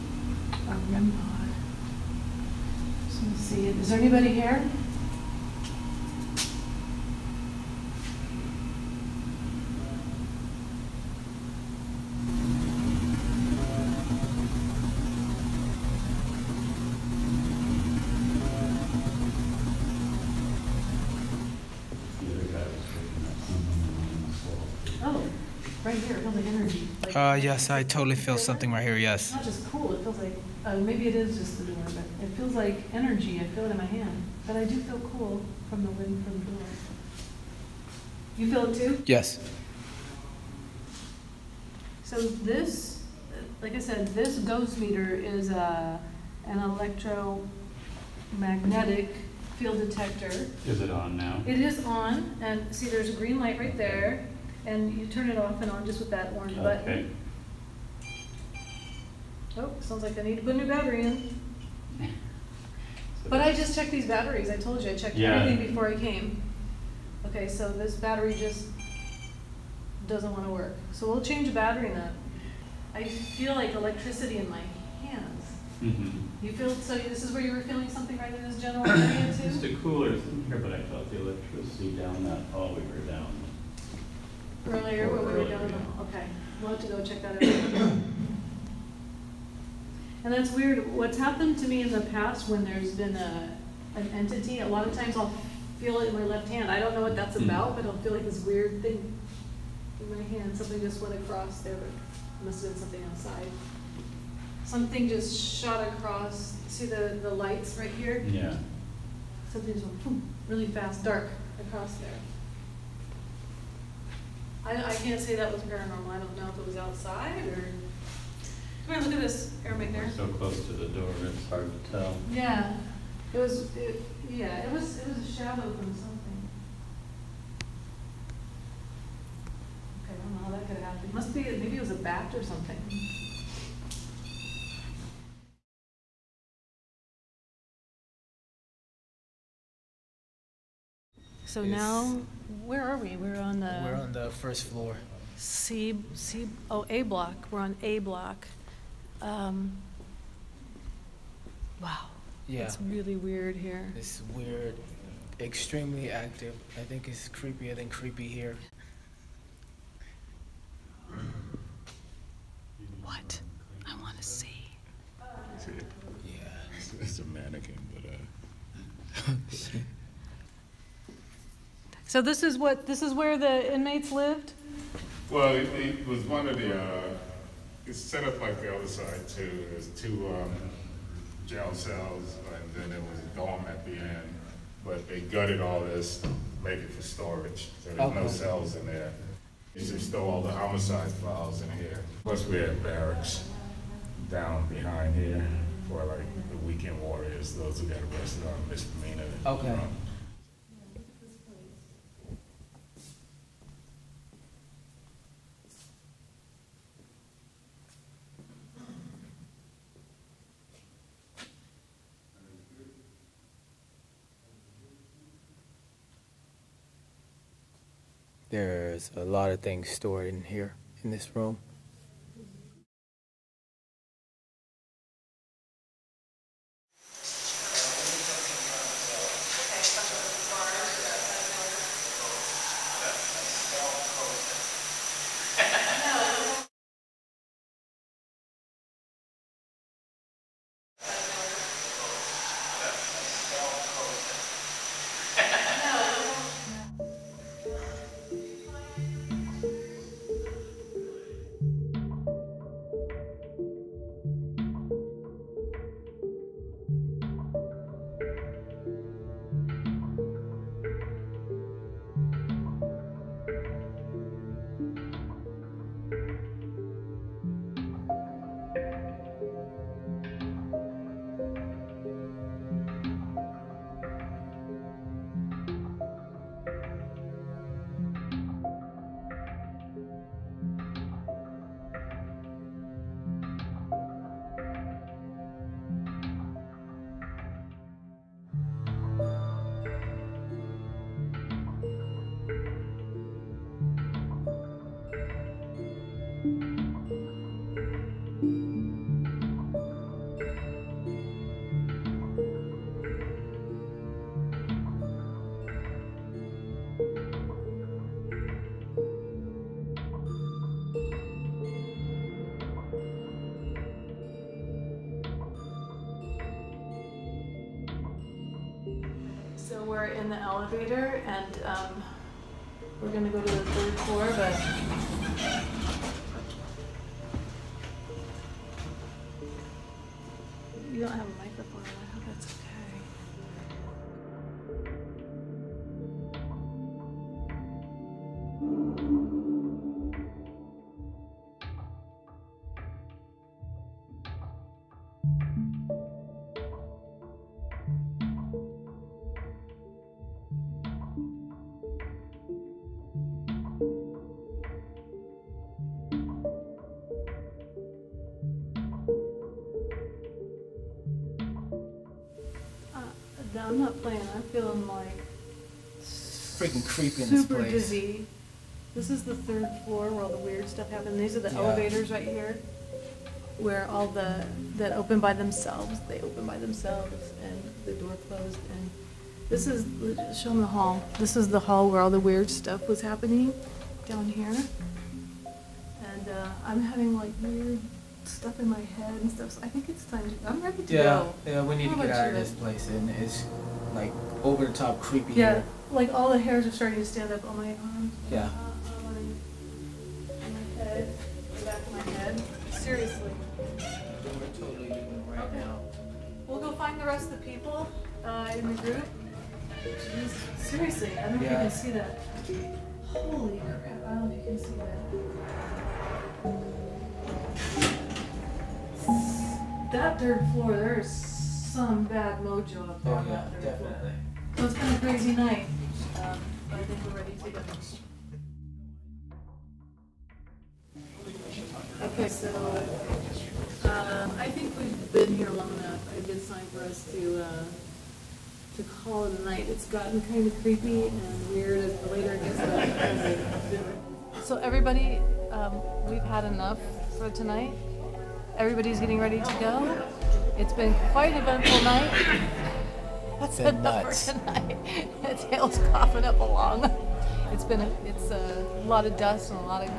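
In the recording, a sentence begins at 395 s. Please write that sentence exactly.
like all the hairs are starting to stand up on my arms.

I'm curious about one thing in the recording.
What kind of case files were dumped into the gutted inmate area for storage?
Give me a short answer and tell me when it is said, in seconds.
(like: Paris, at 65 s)
homicide files, at 190 s.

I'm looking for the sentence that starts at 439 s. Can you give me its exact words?
It's gotten kind of creepy and weird as the later it gets.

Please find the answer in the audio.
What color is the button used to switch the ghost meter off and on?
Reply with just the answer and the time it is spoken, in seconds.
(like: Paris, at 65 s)
orange, at 56 s.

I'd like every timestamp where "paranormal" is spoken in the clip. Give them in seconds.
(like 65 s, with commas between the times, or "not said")
115 s.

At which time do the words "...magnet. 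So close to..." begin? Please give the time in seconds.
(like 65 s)
119 s.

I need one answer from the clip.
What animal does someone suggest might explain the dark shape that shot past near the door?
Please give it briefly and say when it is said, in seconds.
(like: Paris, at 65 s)
a bat, at 131 s.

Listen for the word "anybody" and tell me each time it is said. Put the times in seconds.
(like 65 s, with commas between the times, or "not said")
4 s.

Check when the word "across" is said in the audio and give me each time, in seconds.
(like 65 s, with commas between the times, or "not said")
101 s, 105 s, 111 s.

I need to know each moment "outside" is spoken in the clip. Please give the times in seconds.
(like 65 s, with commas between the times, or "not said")
103 s, 116 s.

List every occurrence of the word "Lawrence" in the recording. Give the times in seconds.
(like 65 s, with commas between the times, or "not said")
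not said.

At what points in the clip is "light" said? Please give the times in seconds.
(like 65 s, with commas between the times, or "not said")
53 s, 107 s.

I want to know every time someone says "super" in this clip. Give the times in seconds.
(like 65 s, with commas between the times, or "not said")
367 s.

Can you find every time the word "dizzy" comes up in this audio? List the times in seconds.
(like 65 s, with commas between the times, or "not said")
367 s.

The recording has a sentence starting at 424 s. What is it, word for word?
So it's been a crazy night, um, but I think we're ready to go.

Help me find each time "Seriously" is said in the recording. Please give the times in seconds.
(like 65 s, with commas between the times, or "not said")
402 s, 410 s.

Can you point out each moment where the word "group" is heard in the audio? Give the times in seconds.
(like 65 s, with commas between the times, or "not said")
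408 s.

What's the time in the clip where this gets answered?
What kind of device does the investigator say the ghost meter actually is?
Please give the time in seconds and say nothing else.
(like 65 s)
46 s.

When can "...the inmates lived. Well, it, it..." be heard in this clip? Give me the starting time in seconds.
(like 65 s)
173 s.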